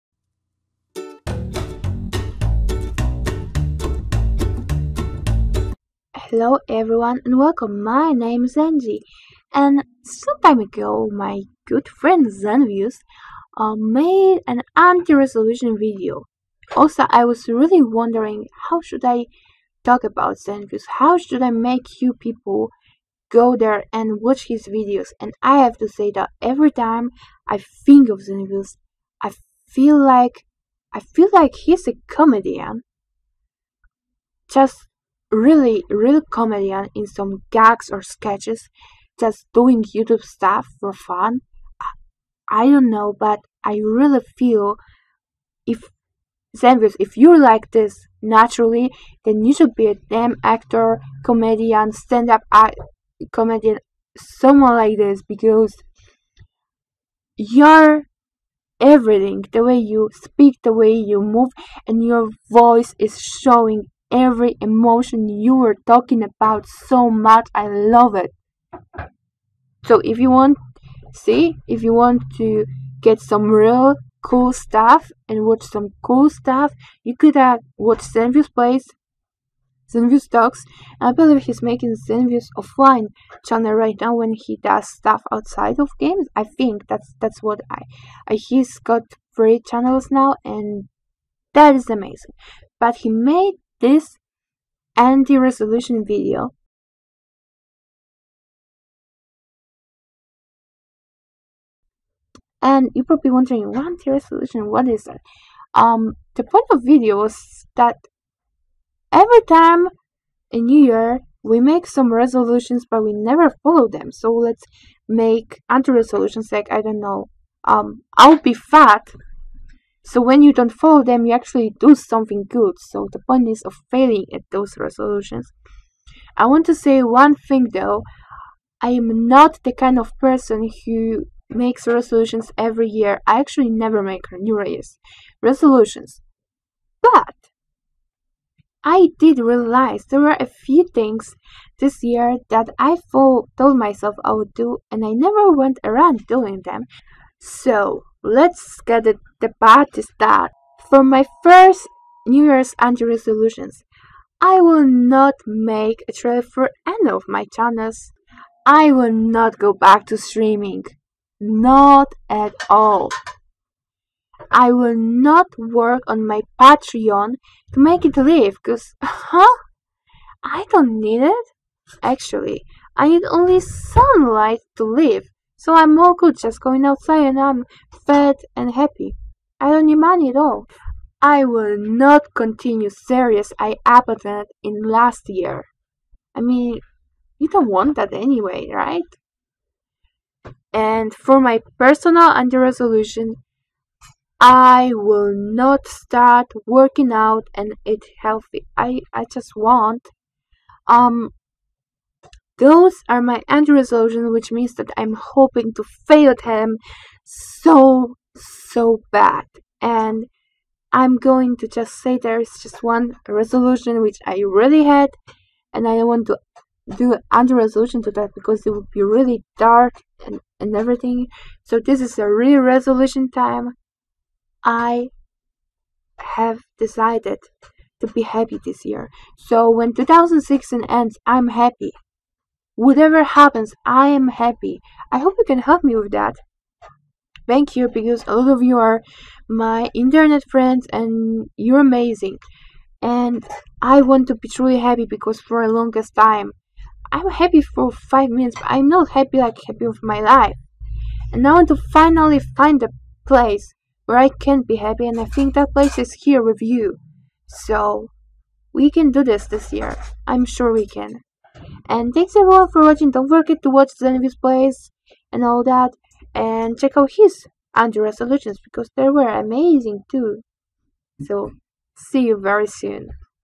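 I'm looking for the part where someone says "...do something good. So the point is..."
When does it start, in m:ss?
2:01.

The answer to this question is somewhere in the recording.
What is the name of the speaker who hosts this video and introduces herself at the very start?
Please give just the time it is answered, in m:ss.
0:08.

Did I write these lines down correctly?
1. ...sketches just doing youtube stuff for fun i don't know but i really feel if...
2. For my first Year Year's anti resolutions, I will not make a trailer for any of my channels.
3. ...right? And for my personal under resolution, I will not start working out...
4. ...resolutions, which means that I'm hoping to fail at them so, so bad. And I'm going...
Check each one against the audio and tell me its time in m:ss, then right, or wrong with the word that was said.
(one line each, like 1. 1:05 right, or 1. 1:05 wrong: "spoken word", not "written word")
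1. 0:38 right
2. 2:30 wrong: "New", not "Year"
3. 3:08 right
4. 3:23 right.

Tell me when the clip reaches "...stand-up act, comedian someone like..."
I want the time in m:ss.
0:51.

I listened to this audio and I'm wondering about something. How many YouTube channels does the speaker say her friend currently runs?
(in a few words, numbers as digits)
3.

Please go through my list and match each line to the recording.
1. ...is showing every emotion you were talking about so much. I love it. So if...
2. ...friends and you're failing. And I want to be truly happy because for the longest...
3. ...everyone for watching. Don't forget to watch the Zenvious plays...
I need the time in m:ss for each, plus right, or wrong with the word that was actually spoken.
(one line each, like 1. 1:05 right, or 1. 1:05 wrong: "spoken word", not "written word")
1. 1:02 right
2. 4:00 wrong: "amazing", not "failing"
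3. 4:22 right.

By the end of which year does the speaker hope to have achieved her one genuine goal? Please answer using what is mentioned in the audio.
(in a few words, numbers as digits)
2016.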